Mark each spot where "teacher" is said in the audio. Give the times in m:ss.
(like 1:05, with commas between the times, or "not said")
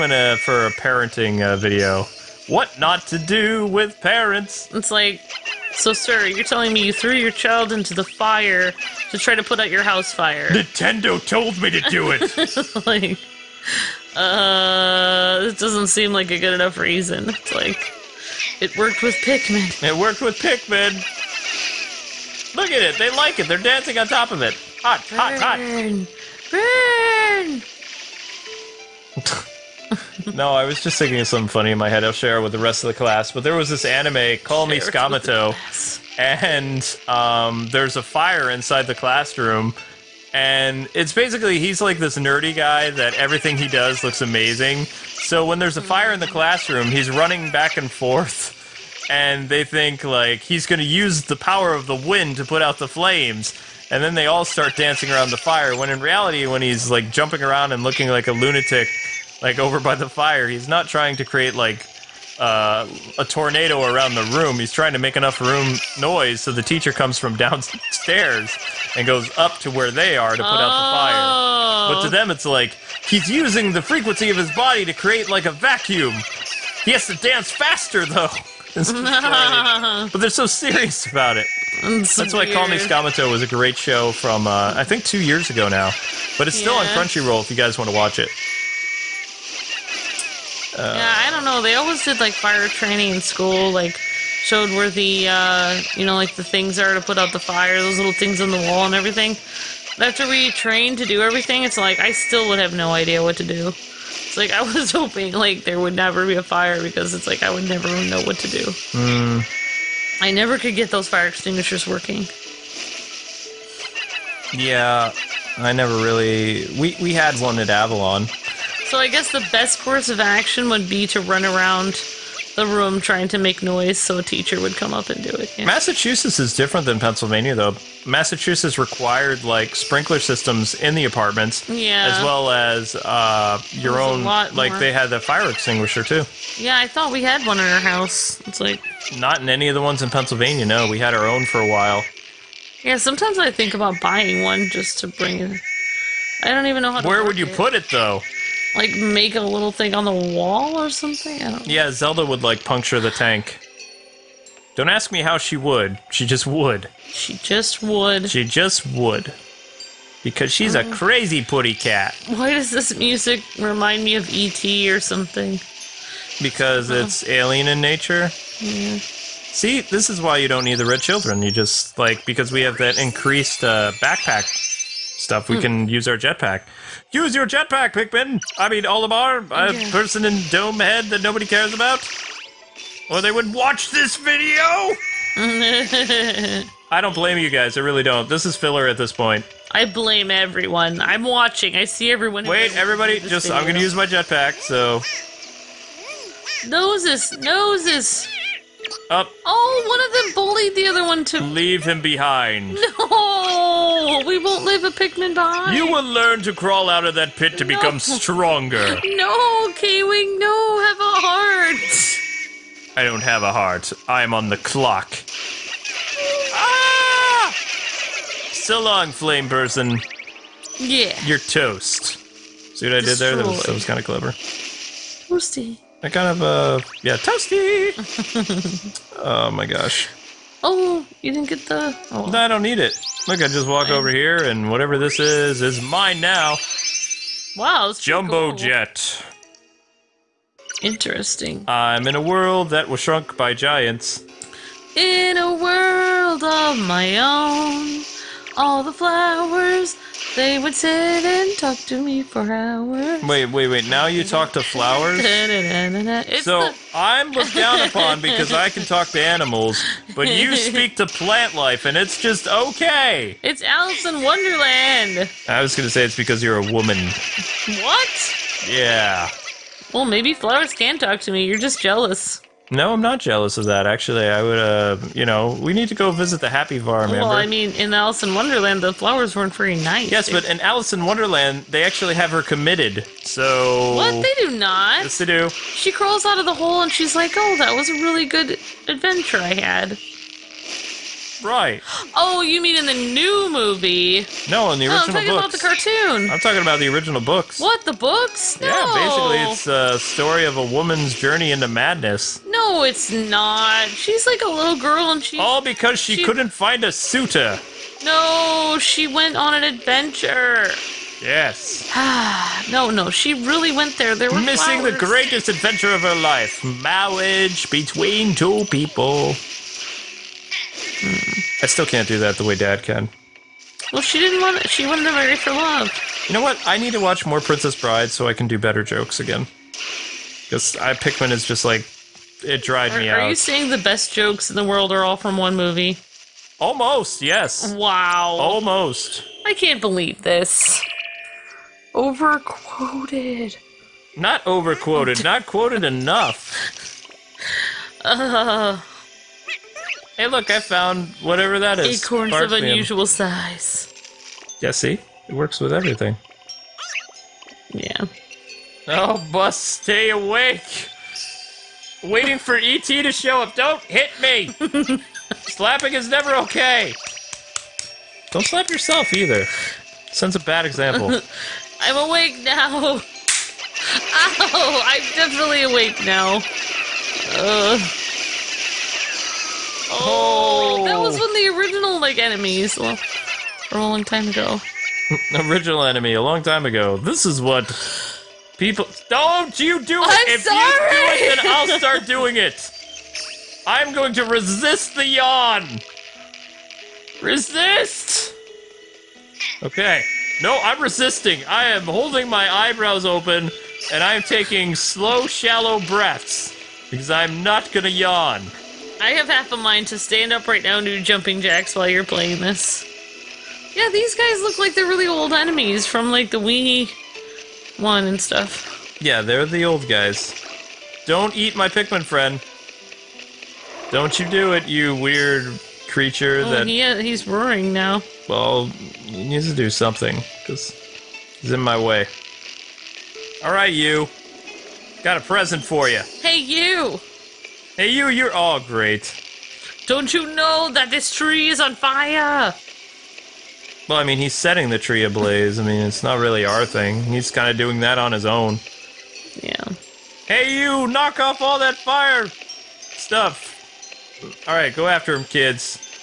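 1:06, 2:04.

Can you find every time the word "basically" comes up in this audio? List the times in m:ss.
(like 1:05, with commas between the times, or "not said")
0:41, 4:59.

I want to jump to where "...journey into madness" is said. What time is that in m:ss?
5:01.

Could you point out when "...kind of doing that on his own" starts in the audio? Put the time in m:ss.
7:27.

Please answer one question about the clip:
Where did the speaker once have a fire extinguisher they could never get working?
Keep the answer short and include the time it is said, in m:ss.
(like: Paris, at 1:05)
Avalon, at 1:57.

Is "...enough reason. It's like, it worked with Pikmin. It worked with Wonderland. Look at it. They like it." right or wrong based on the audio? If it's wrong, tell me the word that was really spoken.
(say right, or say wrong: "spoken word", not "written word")
wrong: "Pikmin", not "Wonderland".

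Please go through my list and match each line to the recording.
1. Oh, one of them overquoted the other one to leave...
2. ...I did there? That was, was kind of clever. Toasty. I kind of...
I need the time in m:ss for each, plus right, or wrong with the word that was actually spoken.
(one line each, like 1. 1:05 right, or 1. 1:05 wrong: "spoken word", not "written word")
1. 3:19 wrong: "bullied", not "overquoted"
2. 3:42 right.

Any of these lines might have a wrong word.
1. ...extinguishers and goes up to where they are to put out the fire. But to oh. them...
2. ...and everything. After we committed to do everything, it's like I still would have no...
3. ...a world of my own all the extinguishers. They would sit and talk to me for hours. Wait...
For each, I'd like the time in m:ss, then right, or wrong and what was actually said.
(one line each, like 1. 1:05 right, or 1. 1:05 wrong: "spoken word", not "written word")
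1. 1:07 wrong: "downstairs", not "extinguishers"
2. 1:38 wrong: "trained", not "committed"
3. 4:05 wrong: "flowers", not "extinguishers".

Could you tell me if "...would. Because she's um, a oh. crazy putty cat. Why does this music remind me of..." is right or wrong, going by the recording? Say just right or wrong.
right.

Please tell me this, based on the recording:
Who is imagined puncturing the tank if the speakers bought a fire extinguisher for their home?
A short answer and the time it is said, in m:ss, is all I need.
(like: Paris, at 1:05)
Zelda, at 2:31.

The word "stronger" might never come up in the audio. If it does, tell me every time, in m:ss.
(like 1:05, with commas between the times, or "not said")
3:27.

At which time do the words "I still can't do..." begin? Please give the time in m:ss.
5:21.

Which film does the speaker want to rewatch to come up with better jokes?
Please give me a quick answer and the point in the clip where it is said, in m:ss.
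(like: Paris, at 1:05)
Princess Bride, at 5:27.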